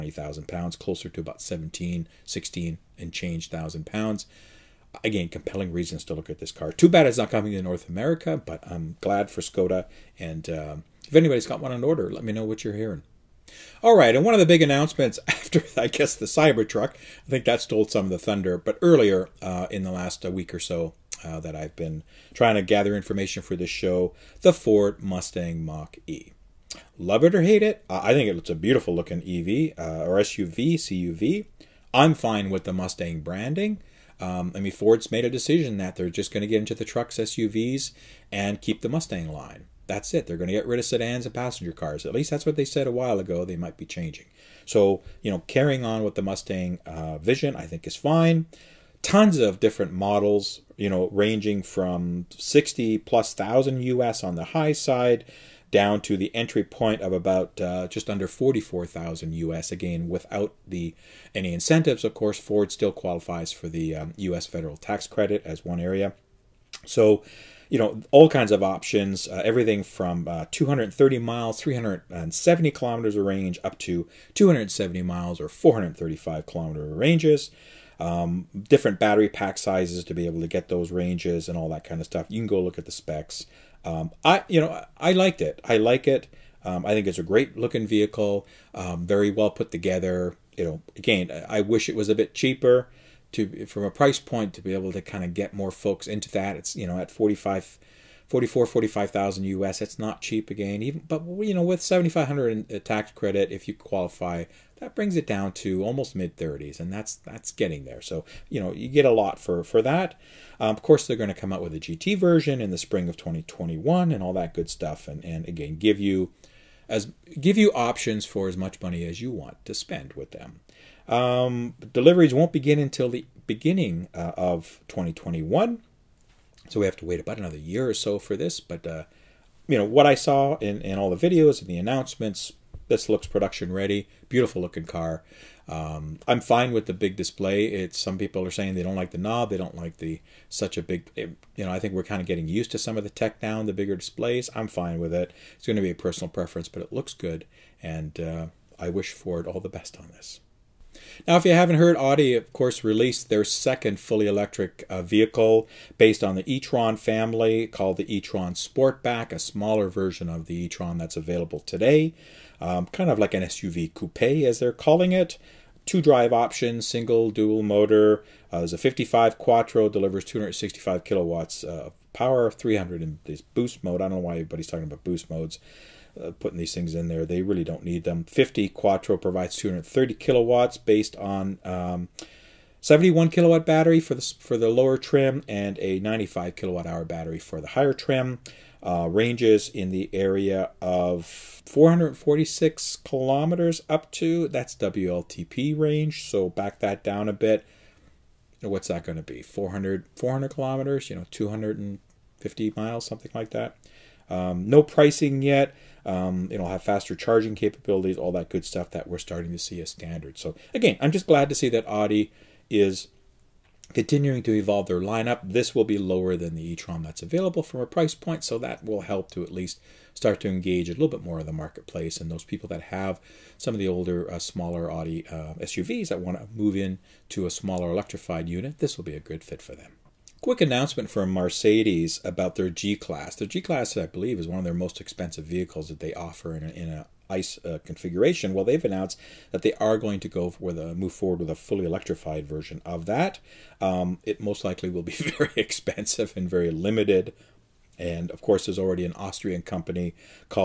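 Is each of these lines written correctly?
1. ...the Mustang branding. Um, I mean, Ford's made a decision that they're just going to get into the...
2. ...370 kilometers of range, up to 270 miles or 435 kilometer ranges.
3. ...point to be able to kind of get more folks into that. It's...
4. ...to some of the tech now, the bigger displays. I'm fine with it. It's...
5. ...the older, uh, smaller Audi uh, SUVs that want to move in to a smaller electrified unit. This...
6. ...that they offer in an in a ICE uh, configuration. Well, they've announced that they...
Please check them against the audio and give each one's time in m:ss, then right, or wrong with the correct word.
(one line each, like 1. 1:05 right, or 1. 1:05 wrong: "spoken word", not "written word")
1. 0:32 right
2. 1:11 right
3. 1:34 right
4. 2:22 right
5. 3:43 right
6. 3:55 right.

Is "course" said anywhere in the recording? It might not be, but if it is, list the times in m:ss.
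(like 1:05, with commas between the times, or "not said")
1:02, 1:50, 2:32, 4:08.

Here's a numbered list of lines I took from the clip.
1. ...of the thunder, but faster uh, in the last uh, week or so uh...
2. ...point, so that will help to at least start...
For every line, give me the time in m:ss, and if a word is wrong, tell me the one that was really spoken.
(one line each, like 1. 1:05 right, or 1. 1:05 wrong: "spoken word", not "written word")
1. 0:18 wrong: "earlier", not "faster"
2. 3:38 right.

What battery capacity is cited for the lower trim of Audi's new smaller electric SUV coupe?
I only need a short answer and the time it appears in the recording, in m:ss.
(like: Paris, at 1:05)
71 kilowatt, at 3:02.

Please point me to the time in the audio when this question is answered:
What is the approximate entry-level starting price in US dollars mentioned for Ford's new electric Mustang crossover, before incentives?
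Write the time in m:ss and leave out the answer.
0:57.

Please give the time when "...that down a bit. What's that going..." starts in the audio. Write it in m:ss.
3:16.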